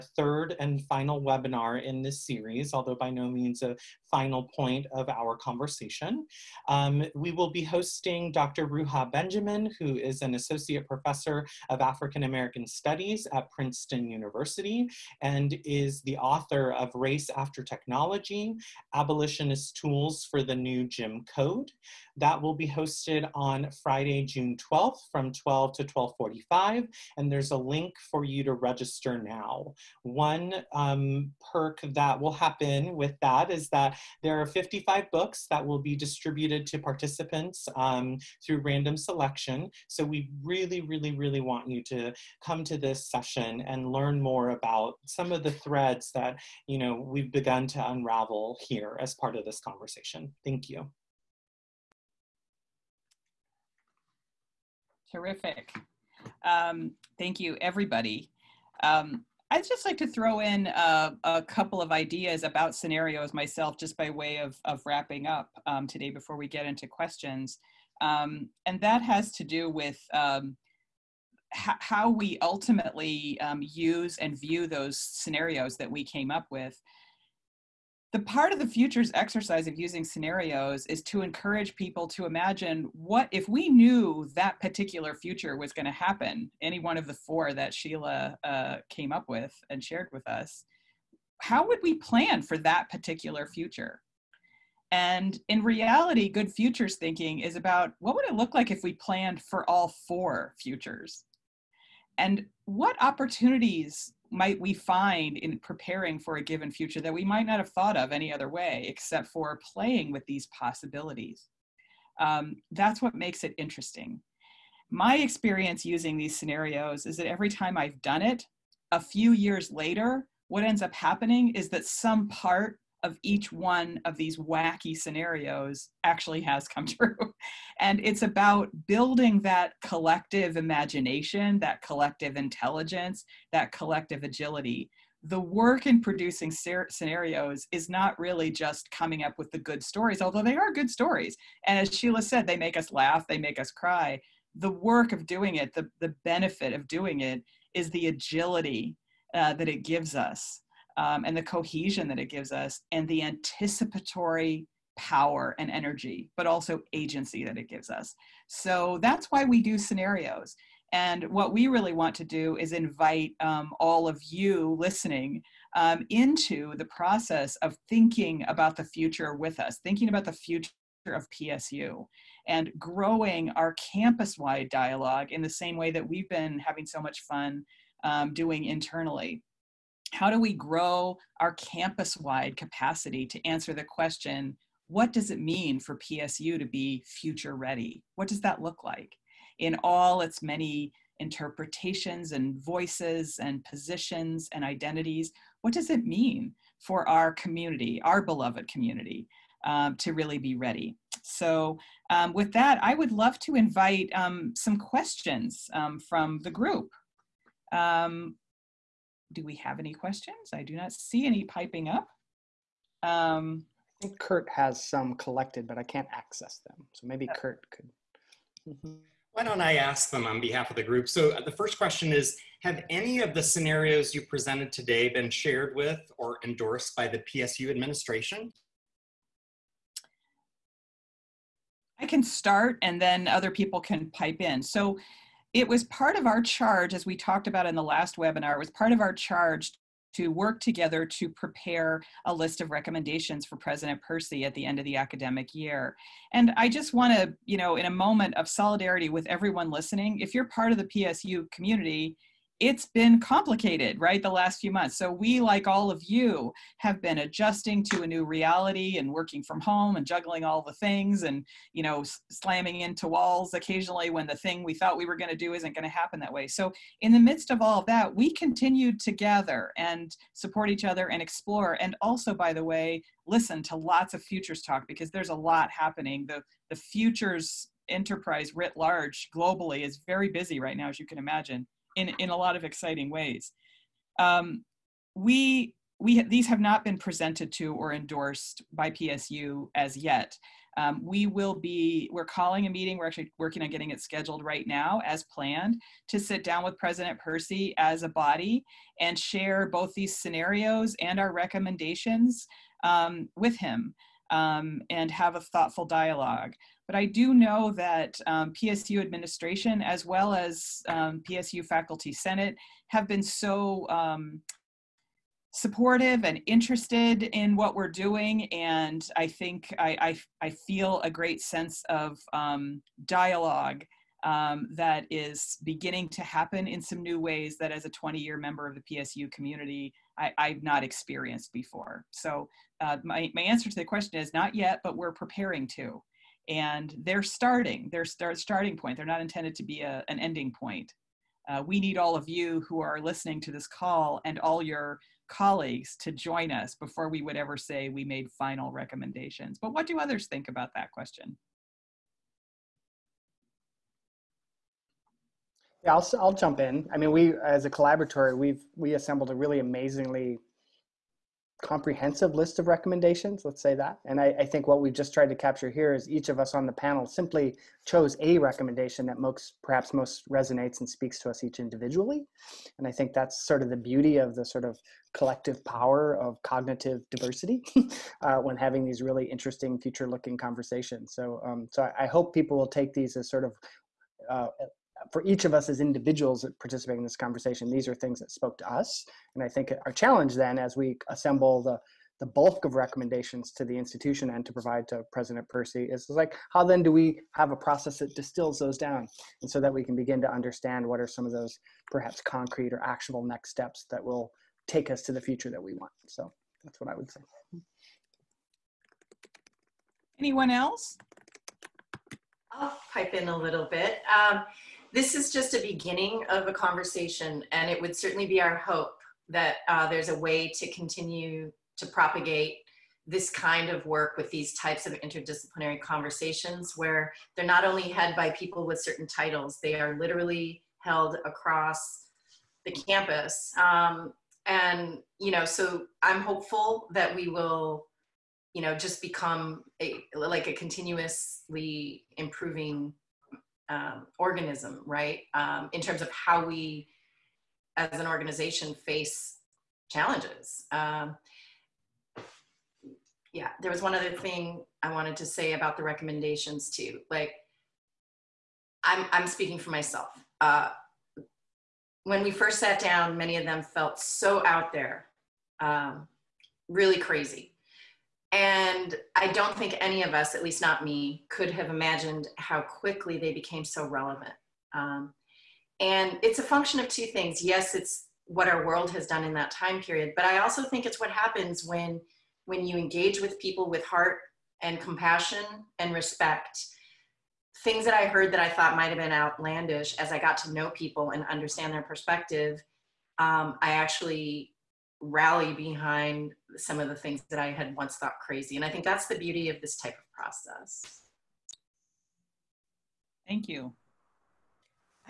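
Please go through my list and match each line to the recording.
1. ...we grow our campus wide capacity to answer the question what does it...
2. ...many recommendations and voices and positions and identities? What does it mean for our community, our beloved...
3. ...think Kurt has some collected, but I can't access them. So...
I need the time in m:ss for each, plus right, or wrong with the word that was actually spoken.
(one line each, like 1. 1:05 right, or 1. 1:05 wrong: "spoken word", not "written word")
1. 3:00 right
2. 3:10 wrong: "interpretations", not "recommendations"
3. 3:34 right.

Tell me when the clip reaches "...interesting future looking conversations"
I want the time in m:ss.
6:19.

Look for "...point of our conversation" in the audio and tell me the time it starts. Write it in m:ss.
0:04.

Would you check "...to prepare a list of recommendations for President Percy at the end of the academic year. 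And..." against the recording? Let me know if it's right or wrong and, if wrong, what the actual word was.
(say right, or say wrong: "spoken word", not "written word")
right.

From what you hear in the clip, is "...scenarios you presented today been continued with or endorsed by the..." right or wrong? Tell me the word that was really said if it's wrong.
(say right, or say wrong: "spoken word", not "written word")
wrong: "shared", not "continued".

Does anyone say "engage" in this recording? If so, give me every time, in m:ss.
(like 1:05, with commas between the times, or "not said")
8:02.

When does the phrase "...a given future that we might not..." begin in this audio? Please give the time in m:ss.
1:46.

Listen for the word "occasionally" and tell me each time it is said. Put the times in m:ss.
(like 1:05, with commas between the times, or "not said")
4:23.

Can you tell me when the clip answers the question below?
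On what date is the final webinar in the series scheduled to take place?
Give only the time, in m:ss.
0:23.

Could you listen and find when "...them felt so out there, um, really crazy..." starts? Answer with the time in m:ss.
7:43.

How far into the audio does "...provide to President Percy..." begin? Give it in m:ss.
6:34.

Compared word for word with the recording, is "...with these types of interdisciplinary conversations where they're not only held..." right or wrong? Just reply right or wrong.
right.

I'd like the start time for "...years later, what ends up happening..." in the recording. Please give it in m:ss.
1:59.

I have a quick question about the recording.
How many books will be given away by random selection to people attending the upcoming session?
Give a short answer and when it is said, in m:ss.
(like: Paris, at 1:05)
55, at 0:34.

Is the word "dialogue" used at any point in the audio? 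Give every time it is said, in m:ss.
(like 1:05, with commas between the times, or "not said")
2:54, 5:05, 5:23.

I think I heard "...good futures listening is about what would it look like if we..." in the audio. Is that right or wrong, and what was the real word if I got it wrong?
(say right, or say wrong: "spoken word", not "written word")
wrong: "thinking", not "listening".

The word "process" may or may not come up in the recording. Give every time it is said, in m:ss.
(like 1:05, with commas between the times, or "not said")
2:46, 6:37, 8:20.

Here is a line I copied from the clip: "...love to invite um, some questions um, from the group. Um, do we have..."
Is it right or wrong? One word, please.
right.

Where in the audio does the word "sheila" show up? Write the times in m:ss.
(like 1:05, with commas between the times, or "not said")
1:27, 2:21.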